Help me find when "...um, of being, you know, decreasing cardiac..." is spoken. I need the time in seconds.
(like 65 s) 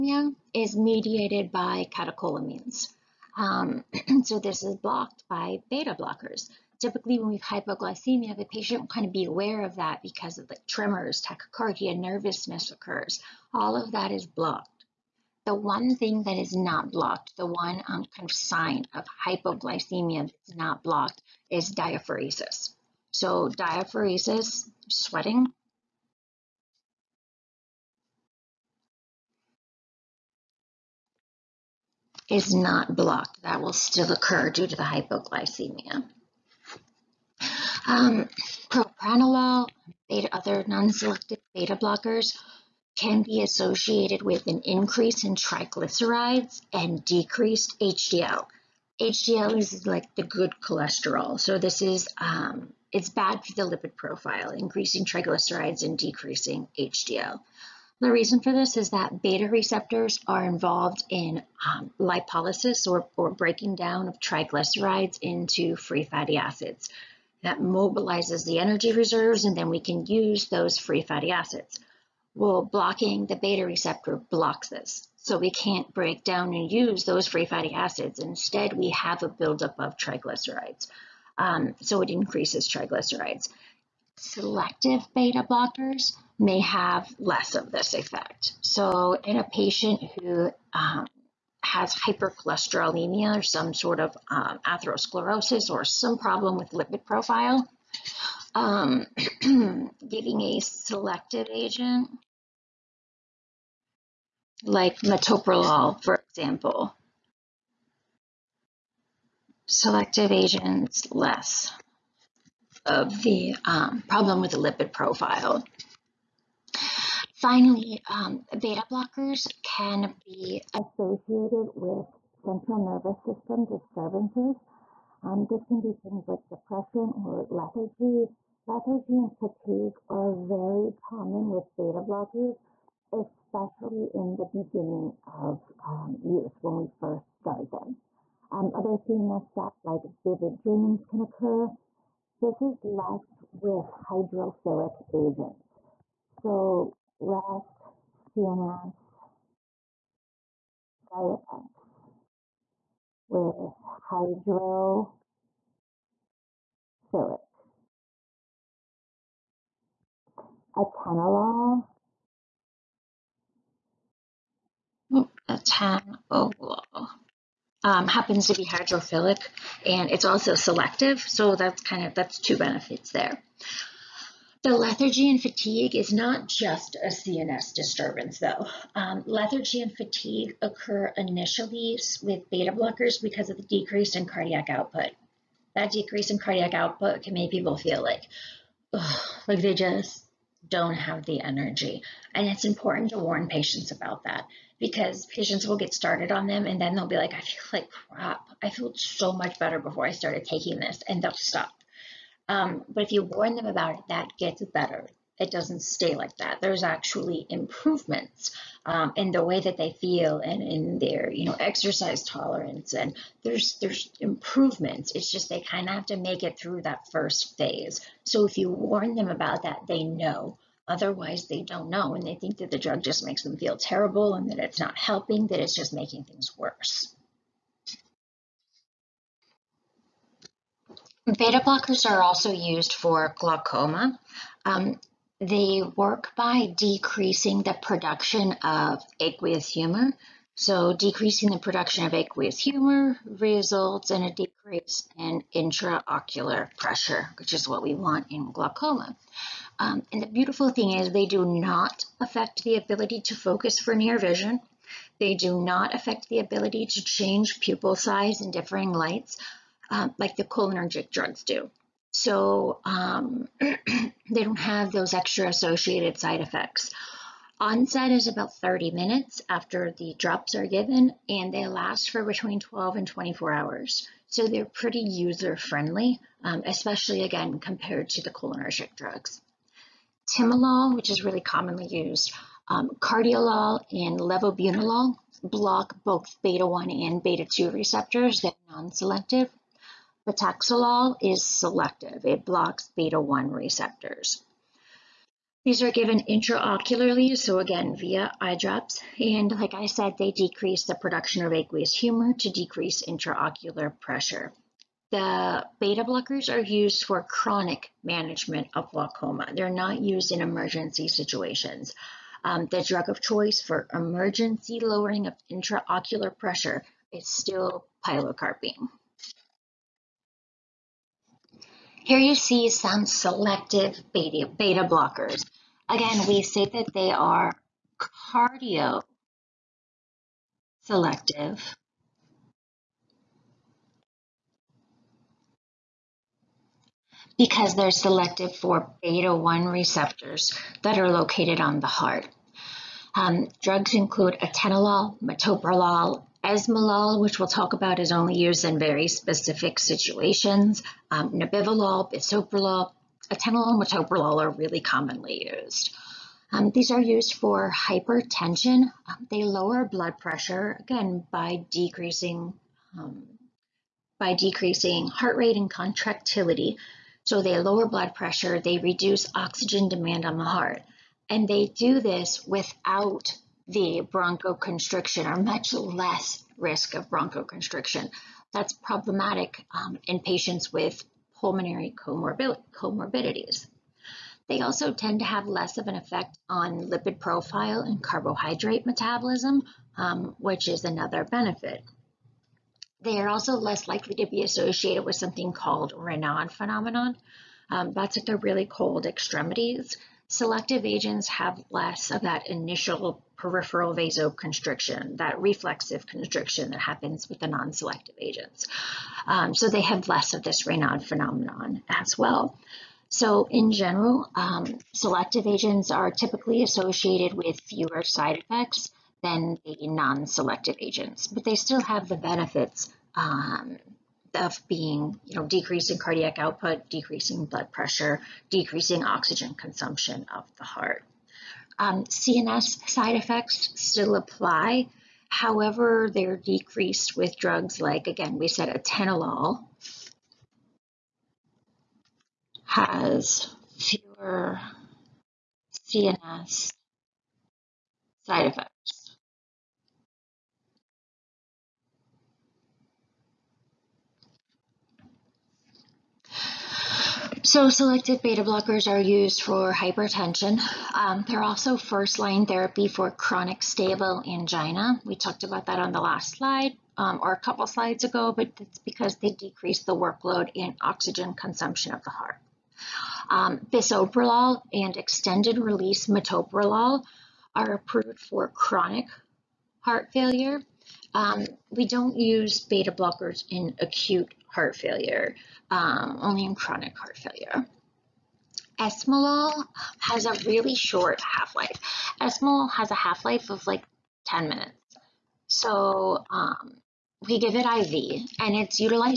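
423 s.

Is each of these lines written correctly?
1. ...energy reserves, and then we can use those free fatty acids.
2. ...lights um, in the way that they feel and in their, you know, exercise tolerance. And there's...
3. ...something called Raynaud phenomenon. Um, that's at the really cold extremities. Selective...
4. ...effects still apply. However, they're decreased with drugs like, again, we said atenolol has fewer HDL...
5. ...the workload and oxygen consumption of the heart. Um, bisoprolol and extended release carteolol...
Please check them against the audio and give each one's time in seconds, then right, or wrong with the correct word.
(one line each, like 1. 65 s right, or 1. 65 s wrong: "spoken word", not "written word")
1. 68 s right
2. 207 s wrong: "improvements", not "lights"
3. 395 s right
4. 433 s wrong: "CNS", not "HDL"
5. 469 s wrong: "metoprolol", not "carteolol".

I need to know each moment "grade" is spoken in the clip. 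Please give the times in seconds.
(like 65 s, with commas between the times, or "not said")
not said.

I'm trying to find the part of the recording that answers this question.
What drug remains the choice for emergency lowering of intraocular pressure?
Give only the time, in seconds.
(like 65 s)
318 s.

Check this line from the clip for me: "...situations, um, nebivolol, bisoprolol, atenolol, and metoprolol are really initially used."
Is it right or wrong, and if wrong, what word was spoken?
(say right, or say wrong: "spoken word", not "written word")
wrong: "commonly", not "initially".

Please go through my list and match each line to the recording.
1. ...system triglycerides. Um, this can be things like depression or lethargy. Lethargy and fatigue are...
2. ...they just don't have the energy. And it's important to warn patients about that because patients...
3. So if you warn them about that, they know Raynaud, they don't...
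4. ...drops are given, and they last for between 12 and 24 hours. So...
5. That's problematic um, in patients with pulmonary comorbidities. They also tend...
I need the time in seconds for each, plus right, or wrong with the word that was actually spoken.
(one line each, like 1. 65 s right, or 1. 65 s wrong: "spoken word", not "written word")
1. 123 s wrong: "disturbances", not "triglycerides"
2. 189 s right
3. 218 s wrong: "Otherwise", not "Raynaud"
4. 270 s right
5. 378 s right.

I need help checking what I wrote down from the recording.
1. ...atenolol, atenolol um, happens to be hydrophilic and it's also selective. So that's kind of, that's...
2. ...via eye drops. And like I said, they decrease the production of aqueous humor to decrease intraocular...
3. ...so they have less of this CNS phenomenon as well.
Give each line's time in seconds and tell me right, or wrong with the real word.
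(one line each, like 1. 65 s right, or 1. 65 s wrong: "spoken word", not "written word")
1. 160 s right
2. 297 s right
3. 409 s wrong: "Raynaud", not "CNS".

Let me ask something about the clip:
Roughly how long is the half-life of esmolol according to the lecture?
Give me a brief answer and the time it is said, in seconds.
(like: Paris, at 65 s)
10 minutes, at 494 s.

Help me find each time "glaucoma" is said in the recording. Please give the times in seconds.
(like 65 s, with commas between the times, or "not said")
233 s, 248 s, 308 s.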